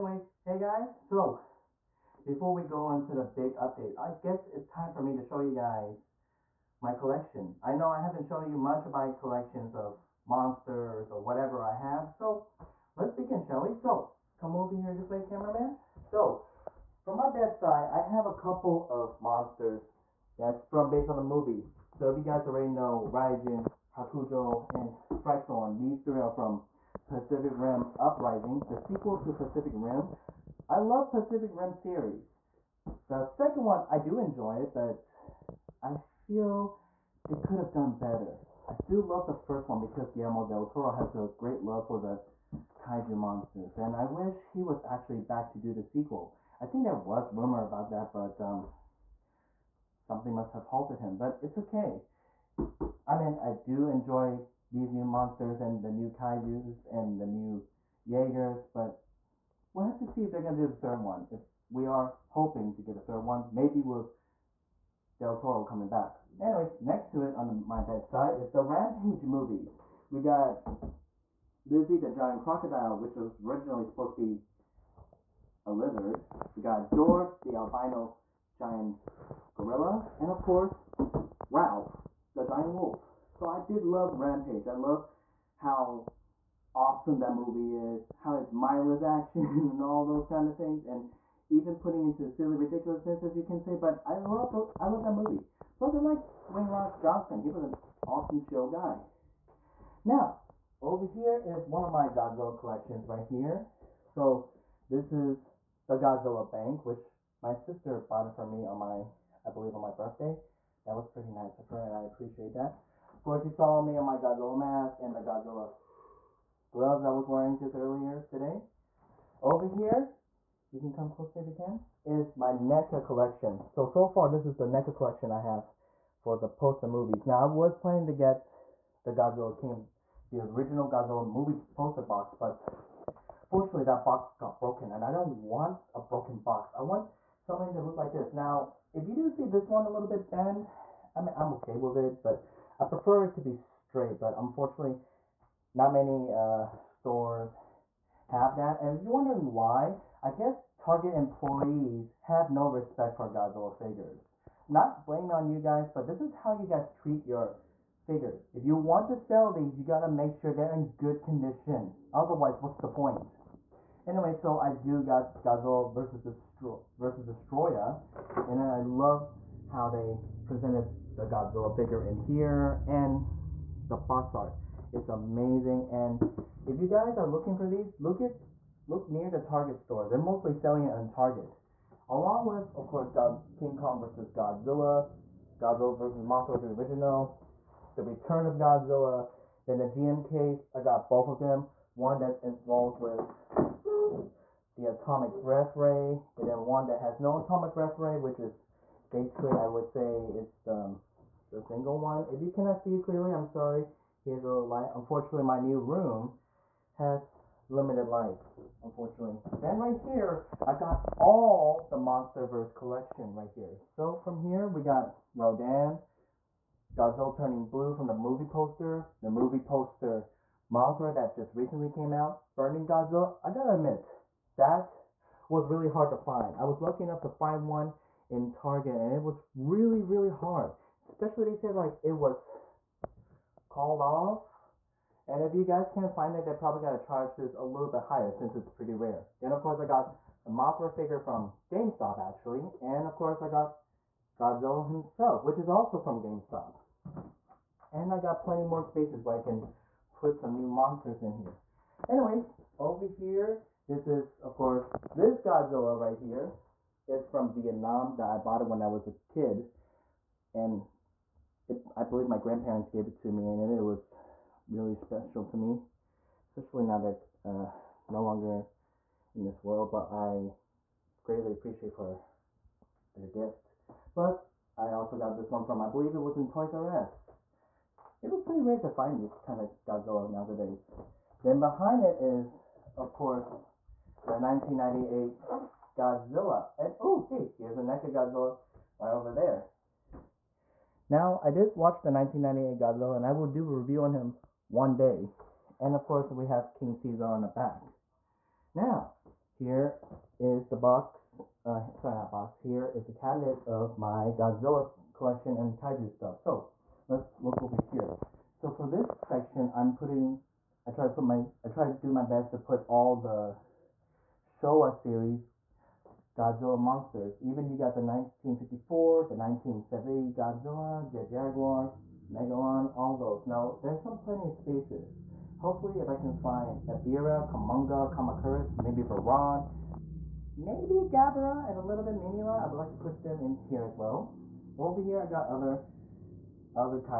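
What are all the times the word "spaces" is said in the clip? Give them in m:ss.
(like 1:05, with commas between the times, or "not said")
4:08, 5:24.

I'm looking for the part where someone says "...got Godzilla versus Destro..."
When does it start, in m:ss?
2:45.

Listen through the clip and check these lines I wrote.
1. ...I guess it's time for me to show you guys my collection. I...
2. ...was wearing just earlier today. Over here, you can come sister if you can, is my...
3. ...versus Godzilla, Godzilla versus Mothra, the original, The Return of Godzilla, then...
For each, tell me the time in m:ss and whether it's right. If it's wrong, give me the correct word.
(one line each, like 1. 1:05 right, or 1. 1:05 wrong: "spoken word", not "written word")
1. 0:03 right
2. 1:57 wrong: "closer", not "sister"
3. 3:04 right.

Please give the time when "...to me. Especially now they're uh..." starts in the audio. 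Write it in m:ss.
4:25.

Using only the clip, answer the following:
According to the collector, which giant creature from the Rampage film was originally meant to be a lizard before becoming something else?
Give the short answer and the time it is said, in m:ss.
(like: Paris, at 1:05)
Lizzie the Giant Crocodile, at 1:11.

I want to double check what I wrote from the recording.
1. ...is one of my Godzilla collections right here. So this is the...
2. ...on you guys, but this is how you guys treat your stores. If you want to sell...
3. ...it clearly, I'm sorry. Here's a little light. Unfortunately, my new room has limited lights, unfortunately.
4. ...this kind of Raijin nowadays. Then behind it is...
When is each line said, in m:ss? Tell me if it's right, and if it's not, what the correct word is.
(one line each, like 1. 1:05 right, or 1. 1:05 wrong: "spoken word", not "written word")
1. 1:41 right
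2. 2:35 wrong: "figures", not "stores"
3. 3:22 right
4. 4:39 wrong: "Godzilla", not "Raijin".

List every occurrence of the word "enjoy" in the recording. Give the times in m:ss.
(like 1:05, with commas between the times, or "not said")
0:34, 0:53.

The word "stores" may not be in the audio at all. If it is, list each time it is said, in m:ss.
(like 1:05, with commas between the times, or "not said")
2:26, 2:59.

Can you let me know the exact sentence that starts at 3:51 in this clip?
Especially they said like it was called off.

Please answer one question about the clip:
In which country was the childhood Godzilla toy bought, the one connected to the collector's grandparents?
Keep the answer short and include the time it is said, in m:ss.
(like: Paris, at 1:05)
Vietnam, at 4:17.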